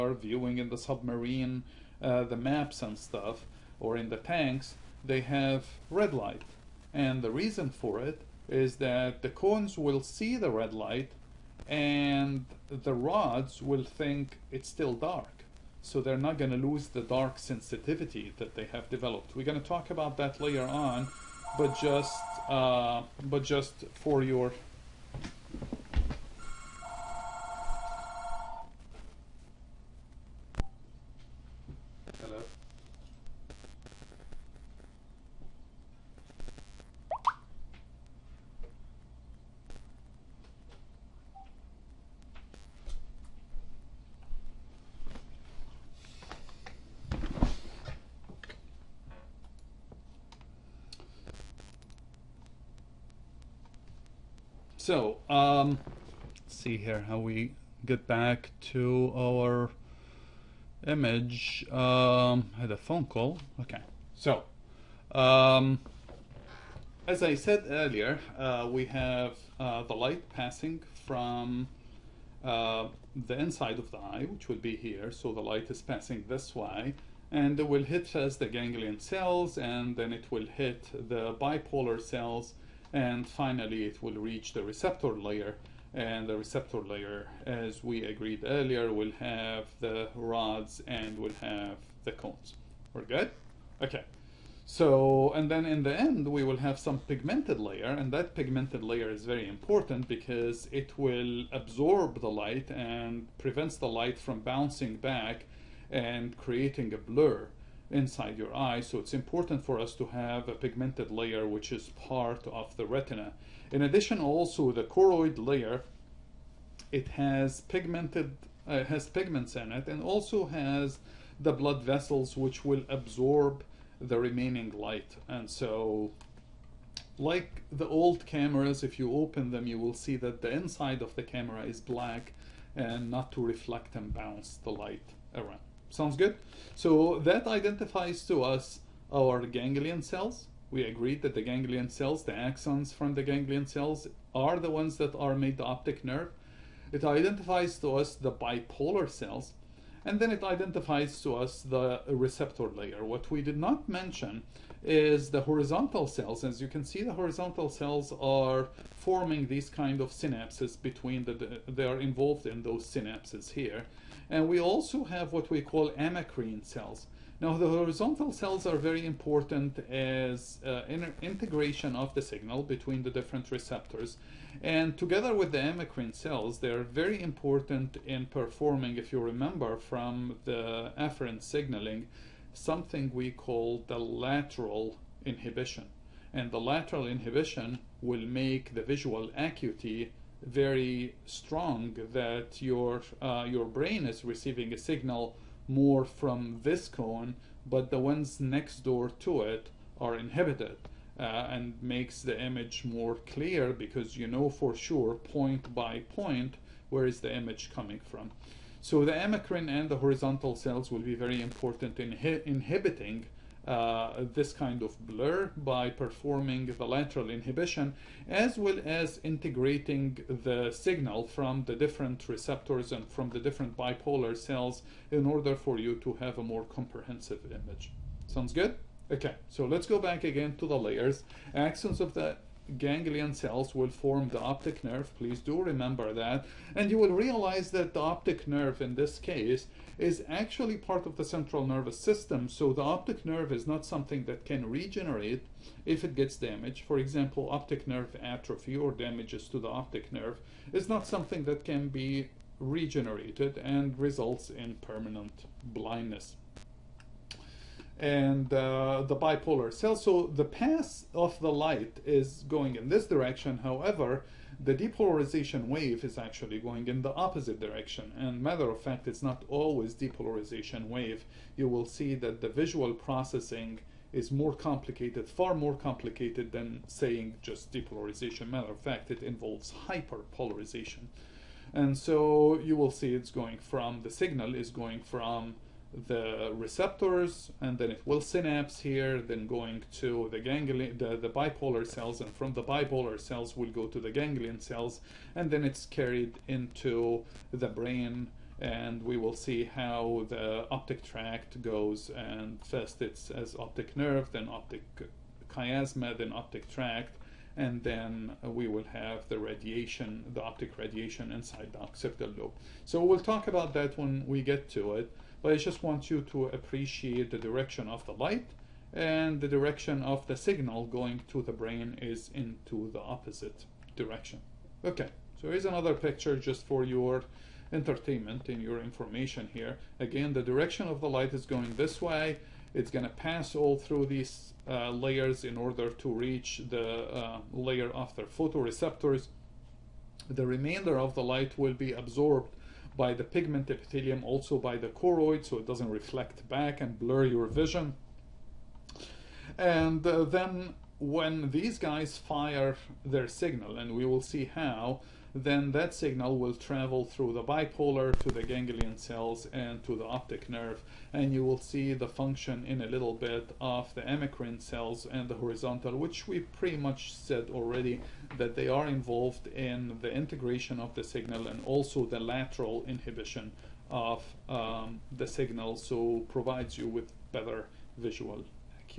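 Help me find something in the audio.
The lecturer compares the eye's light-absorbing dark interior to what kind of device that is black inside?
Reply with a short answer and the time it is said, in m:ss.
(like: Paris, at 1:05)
Old cameras, at 2:07.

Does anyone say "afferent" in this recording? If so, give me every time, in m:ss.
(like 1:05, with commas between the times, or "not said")
3:00.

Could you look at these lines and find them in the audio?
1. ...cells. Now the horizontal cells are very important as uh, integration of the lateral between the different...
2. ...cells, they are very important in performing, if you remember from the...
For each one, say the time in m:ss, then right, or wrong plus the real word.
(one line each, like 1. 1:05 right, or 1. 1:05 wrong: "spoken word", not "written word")
1. 2:46 wrong: "signal", not "lateral"
2. 2:56 right.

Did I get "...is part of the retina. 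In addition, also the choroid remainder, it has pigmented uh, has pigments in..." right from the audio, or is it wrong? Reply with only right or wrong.
wrong.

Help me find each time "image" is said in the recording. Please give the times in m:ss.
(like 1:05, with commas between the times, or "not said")
1:00, 3:22, 3:27, 3:47.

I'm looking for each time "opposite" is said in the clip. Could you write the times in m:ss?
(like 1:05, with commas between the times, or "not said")
4:27, 5:23.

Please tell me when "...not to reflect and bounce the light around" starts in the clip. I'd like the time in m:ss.
2:13.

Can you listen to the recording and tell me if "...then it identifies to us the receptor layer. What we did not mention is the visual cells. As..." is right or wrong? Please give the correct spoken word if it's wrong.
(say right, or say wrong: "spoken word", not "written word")
wrong: "horizontal", not "visual".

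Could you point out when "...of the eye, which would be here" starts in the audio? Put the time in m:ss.
1:13.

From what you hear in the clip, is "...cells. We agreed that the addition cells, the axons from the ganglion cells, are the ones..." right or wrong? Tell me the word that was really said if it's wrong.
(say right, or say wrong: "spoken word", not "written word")
wrong: "ganglion", not "addition".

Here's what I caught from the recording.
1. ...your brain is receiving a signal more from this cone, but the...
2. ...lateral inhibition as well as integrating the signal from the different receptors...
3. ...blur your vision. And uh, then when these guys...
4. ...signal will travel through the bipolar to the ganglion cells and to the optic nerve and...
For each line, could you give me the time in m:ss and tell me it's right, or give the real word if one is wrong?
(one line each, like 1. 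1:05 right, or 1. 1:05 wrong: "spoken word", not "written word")
1. 3:13 right
2. 3:36 right
3. 5:46 right
4. 5:55 right.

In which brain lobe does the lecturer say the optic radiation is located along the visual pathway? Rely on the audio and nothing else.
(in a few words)
Occipital lobe.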